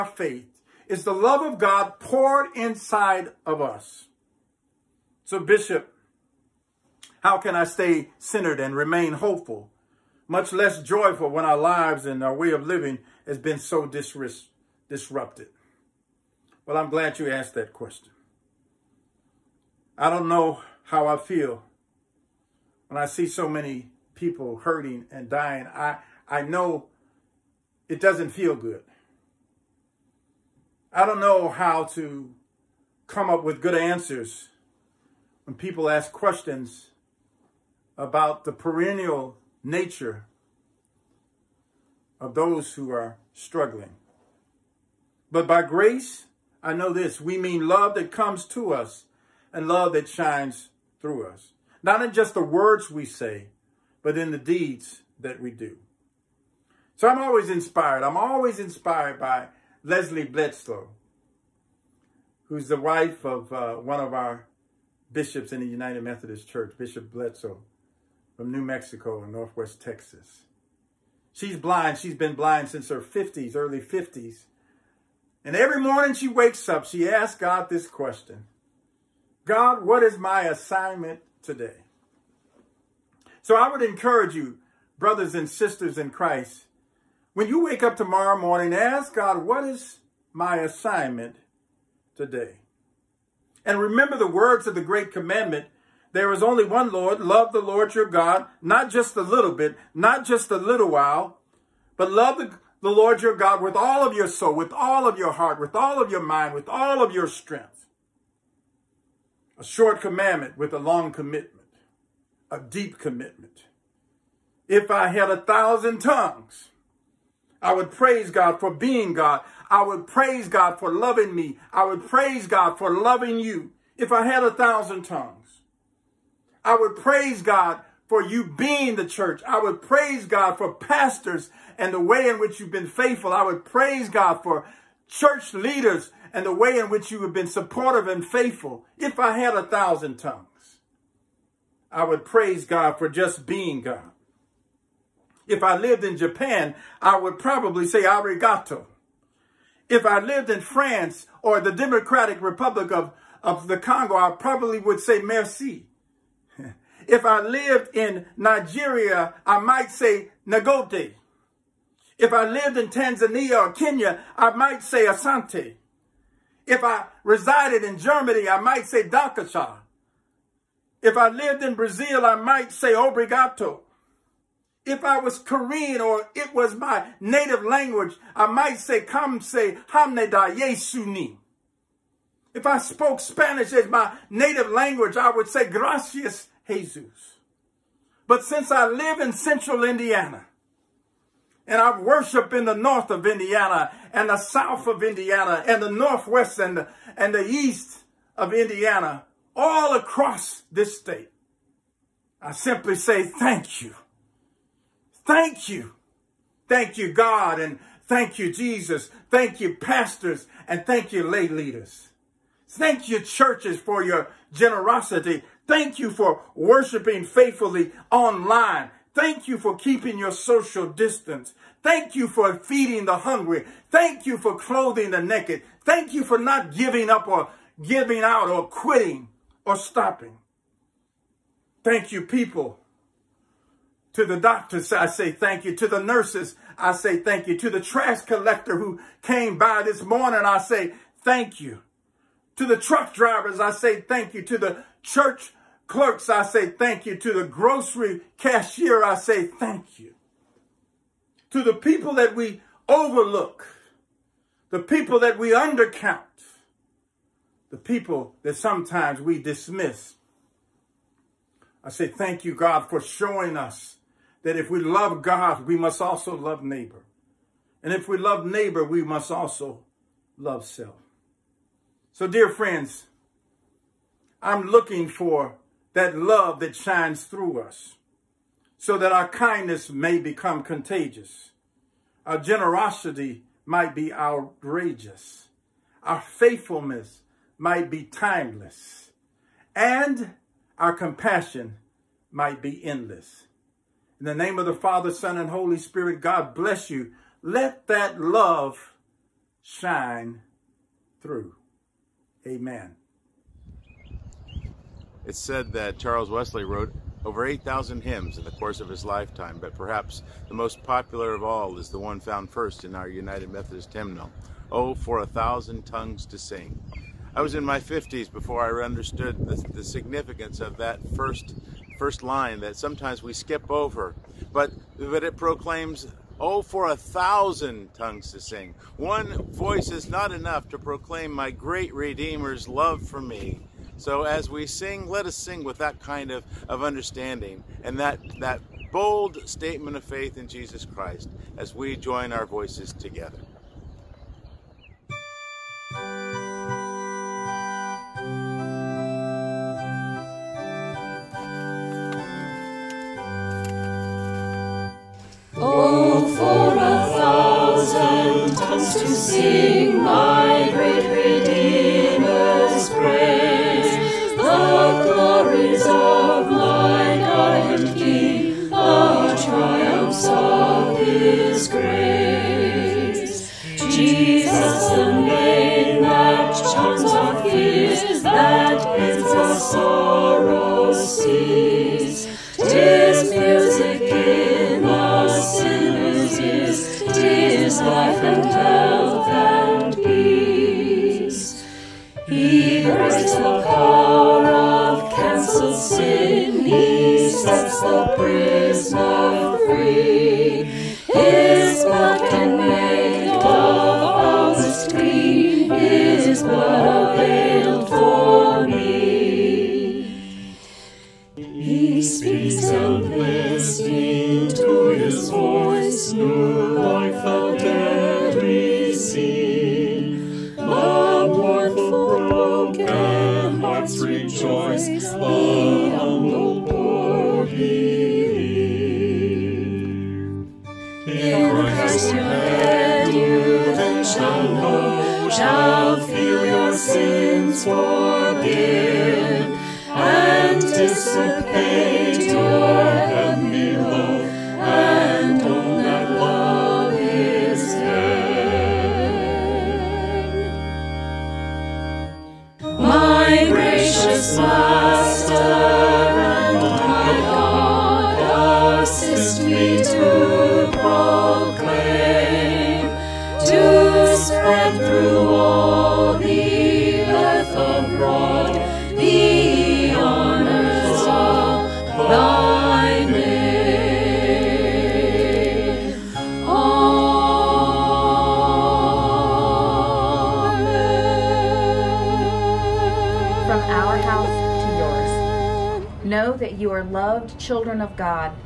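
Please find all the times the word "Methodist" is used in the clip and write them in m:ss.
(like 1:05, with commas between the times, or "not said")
1:06, 5:13.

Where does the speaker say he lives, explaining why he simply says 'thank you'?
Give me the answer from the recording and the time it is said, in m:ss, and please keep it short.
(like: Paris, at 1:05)
central Indiana, at 3:09.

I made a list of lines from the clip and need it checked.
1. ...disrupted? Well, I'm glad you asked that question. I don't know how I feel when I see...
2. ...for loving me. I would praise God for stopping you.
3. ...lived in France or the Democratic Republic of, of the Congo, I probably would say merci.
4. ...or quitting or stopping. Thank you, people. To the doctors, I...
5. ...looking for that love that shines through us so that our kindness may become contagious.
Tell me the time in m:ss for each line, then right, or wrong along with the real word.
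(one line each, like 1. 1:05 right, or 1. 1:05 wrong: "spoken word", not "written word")
1. 0:14 right
2. 2:00 wrong: "loving", not "stopping"
3. 2:30 right
4. 3:48 right
5. 4:34 right.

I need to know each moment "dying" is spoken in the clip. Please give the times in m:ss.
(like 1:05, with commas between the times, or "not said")
0:25.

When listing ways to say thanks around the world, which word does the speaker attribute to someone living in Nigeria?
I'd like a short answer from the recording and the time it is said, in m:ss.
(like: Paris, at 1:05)
Nagote, at 2:40.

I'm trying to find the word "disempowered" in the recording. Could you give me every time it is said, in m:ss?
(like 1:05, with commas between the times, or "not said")
not said.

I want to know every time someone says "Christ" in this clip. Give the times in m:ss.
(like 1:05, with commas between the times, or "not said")
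1:26, 5:40.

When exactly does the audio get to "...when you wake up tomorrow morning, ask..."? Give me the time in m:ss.
1:27.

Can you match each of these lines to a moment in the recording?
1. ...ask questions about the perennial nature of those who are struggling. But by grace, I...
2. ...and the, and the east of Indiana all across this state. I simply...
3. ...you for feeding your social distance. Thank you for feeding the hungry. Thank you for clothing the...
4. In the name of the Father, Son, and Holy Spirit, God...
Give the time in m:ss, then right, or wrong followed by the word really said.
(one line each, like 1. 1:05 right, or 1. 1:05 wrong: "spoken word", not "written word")
1. 0:35 right
2. 3:16 right
3. 3:39 wrong: "keeping", not "feeding"
4. 4:54 right.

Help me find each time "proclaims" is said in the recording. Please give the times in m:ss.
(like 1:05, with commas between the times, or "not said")
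5:25, 5:30.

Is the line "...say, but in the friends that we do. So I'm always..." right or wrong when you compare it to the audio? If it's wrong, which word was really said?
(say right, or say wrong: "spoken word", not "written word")
wrong: "deeds", not "friends".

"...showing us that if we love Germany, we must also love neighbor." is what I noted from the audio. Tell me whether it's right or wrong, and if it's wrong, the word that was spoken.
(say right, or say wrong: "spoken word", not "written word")
wrong: "God", not "Germany".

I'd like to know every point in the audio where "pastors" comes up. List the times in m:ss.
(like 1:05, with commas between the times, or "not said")
2:10, 3:29.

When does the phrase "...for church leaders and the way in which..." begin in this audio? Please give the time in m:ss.
2:14.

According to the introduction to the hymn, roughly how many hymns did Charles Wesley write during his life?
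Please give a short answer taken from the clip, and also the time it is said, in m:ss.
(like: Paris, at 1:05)
8000, at 5:07.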